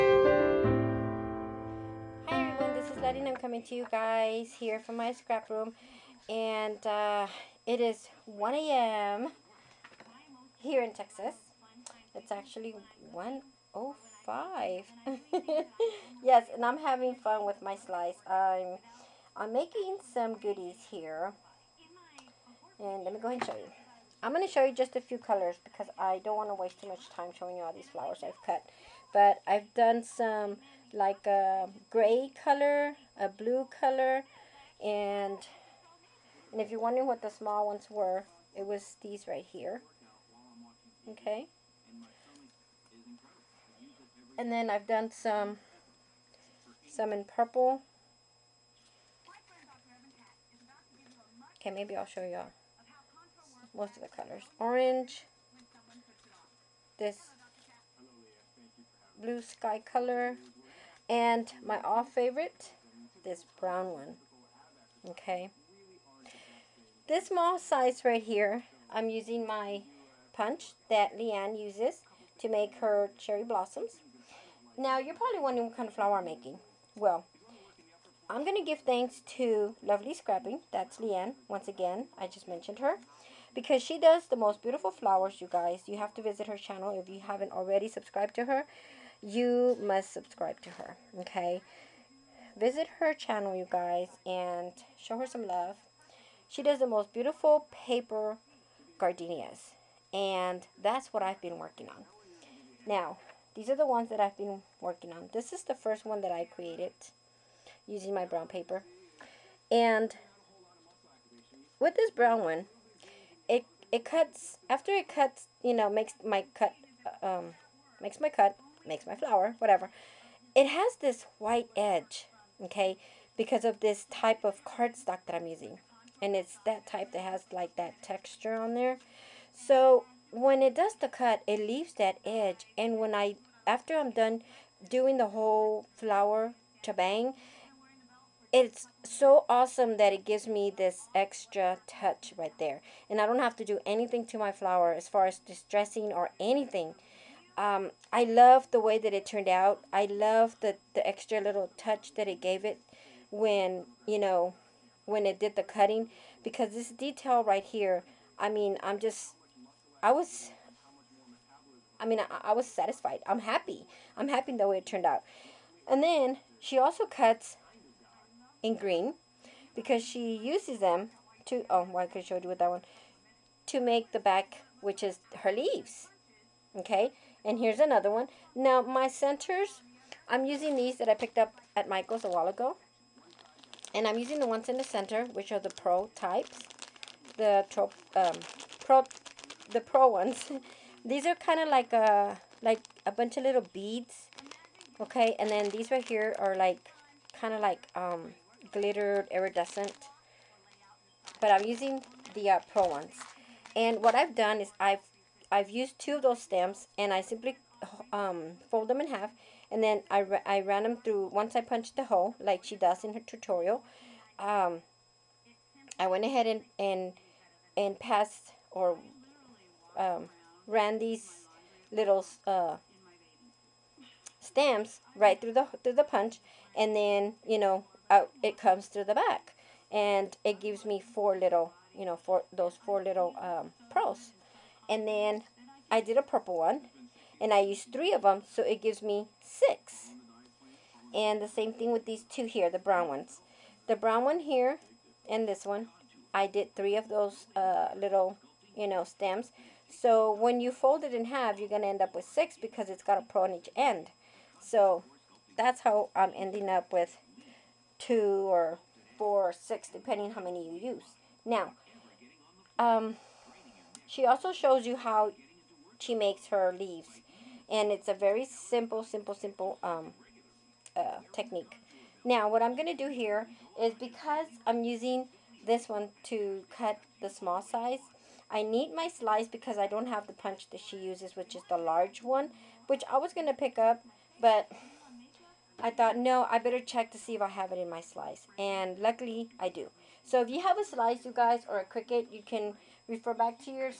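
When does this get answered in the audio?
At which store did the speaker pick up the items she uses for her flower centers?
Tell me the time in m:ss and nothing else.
3:01.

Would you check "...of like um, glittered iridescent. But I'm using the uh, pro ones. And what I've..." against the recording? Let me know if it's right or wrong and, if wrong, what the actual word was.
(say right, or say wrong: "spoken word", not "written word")
right.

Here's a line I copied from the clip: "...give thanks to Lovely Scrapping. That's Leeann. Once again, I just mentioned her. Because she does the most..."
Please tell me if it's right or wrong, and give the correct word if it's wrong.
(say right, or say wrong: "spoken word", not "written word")
right.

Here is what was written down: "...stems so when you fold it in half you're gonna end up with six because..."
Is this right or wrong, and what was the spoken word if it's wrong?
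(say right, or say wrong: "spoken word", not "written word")
right.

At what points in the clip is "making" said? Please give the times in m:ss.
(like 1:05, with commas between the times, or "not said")
0:19, 1:16.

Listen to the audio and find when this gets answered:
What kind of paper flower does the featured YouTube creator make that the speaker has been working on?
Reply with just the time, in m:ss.
1:37.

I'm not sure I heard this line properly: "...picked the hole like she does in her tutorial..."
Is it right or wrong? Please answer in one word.
wrong.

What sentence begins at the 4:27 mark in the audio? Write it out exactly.
And it's a very simple, simple, simple um, uh, technique.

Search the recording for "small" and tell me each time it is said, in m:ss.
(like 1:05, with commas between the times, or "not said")
0:37, 1:07, 4:37.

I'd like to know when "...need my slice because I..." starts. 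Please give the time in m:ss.
4:38.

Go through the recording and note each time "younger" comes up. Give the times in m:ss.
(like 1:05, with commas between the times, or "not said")
not said.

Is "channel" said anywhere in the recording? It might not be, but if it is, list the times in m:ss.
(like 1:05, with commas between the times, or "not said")
1:26, 1:33.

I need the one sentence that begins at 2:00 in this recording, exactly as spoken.
It has this white edge, okay, because of this type of cardstock that I'm using.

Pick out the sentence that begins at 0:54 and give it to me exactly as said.
Orange, this blue sky color, and my all favorite, this brown one.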